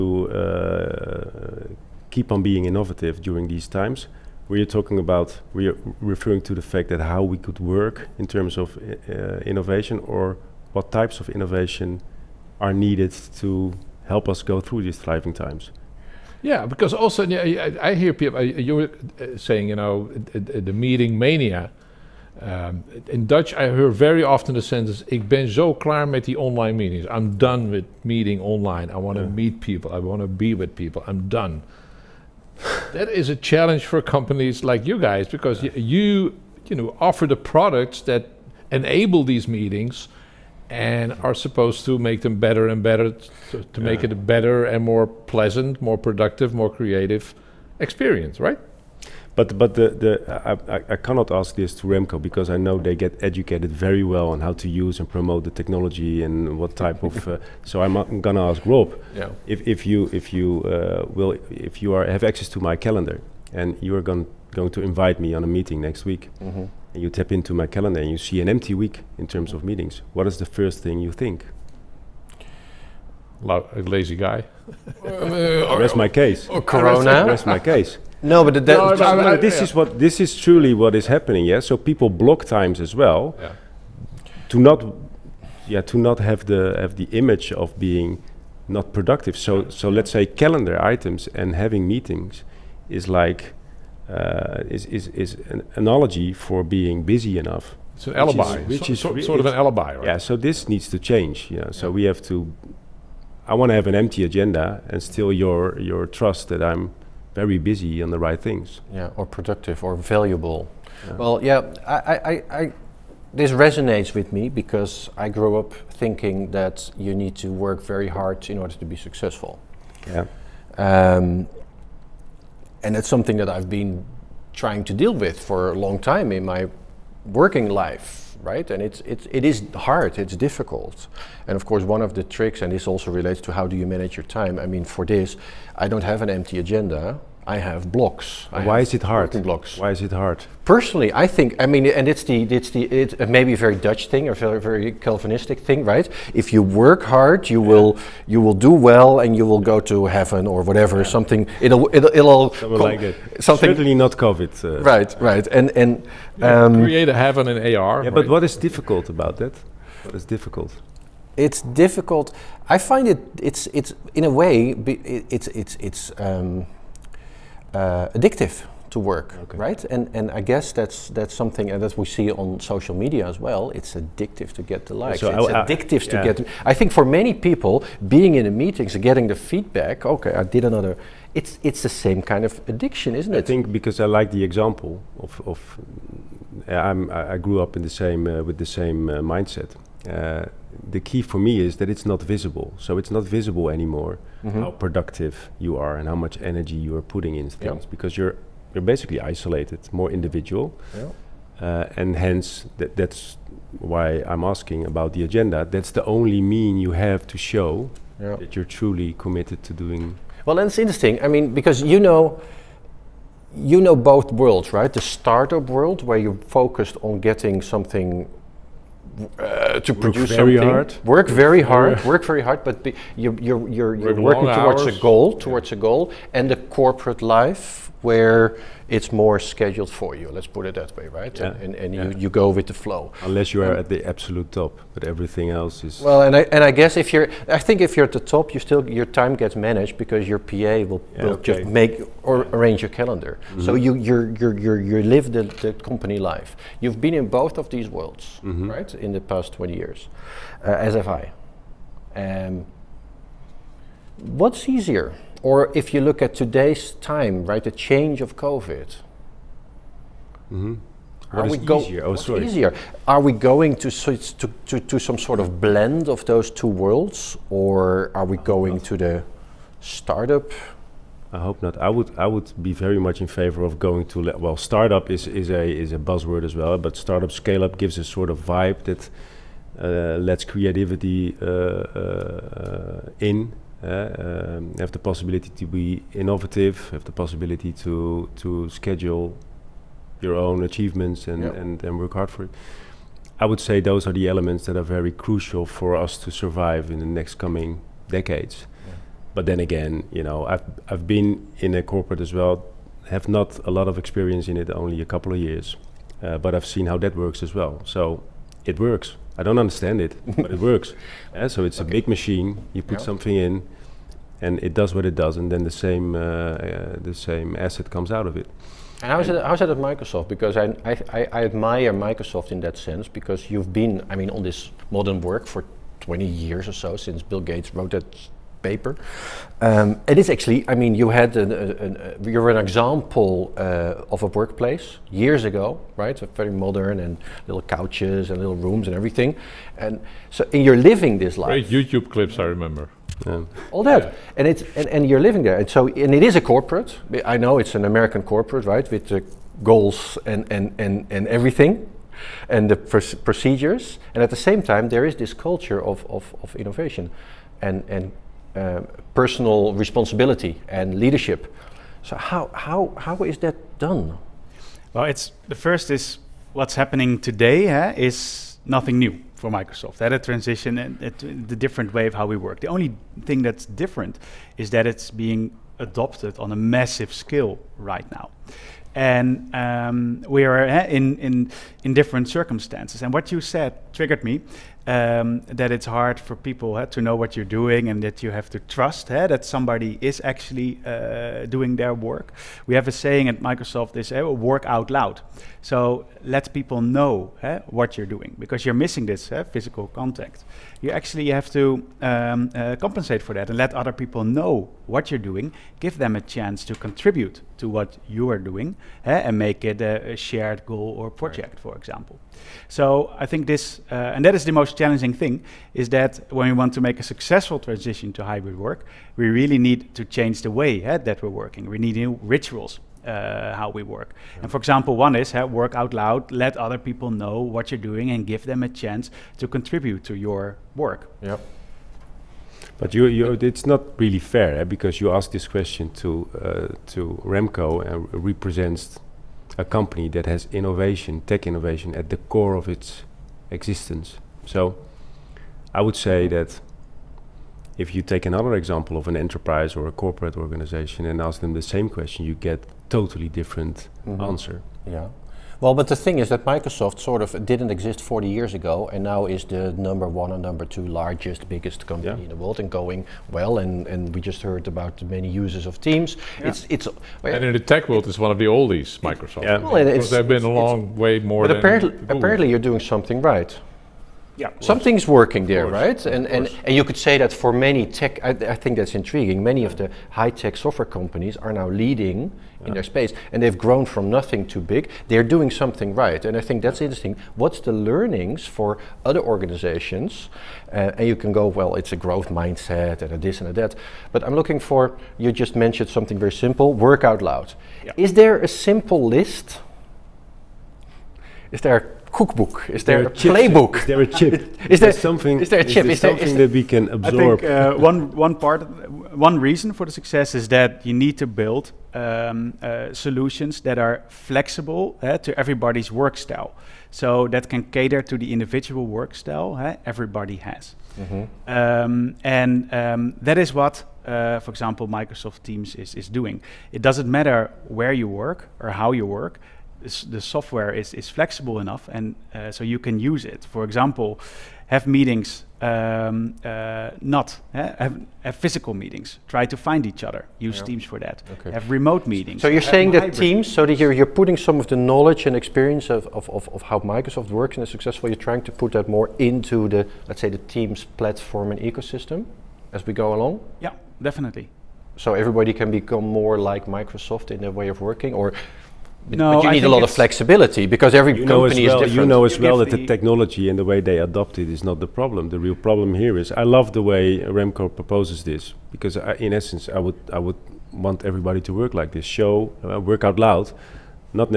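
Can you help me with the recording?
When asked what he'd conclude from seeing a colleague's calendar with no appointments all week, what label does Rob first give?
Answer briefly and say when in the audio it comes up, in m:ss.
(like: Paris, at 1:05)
a lazy guy, at 1:13.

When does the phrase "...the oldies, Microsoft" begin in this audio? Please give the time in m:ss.
7:48.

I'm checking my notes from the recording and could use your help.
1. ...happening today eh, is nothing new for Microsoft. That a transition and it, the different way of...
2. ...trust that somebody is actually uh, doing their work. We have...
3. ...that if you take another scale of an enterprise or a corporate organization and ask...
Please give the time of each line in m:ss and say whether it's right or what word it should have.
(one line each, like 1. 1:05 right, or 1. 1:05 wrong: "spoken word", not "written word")
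1. 6:06 right
2. 6:28 right
3. 7:26 wrong: "example", not "scale".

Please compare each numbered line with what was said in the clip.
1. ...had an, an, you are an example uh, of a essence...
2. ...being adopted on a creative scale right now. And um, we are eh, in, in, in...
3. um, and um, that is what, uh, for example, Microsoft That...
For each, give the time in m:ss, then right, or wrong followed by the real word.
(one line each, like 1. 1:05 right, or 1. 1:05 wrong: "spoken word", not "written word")
1. 5:31 wrong: "workplace", not "essence"
2. 6:15 wrong: "massive", not "creative"
3. 8:41 wrong: "Teams", not "That".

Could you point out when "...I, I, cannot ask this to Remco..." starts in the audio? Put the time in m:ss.
0:50.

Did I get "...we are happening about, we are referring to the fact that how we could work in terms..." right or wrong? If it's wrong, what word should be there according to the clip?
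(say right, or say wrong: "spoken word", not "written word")
wrong: "talking", not "happening".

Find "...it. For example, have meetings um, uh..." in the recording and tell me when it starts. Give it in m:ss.
8:53.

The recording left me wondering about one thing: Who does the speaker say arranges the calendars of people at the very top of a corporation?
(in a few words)
PA.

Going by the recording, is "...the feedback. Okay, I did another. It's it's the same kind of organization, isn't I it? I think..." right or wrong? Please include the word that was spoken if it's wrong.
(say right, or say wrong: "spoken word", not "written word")
wrong: "addiction", not "organization".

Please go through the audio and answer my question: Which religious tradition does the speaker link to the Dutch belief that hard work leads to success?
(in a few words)
Calvinistic.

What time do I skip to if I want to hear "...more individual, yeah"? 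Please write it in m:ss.
3:19.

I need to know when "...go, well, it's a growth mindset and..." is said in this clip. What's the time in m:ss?
8:11.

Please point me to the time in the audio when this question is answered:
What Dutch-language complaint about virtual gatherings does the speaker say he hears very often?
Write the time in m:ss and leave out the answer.
0:25.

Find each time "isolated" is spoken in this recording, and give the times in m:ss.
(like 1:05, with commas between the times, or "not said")
3:19.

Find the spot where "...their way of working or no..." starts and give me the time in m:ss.
9:17.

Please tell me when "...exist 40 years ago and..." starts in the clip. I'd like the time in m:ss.
7:37.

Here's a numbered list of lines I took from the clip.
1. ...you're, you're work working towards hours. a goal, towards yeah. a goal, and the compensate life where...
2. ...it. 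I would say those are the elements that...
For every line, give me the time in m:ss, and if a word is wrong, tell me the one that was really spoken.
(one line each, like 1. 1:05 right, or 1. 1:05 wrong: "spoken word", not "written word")
1. 3:43 wrong: "corporate", not "compensate"
2. 4:52 right.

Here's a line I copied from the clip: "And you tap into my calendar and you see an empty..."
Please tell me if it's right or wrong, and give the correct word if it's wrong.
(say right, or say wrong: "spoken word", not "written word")
right.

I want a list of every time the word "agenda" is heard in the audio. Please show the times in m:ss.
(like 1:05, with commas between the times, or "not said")
1:44, 2:16, 3:25.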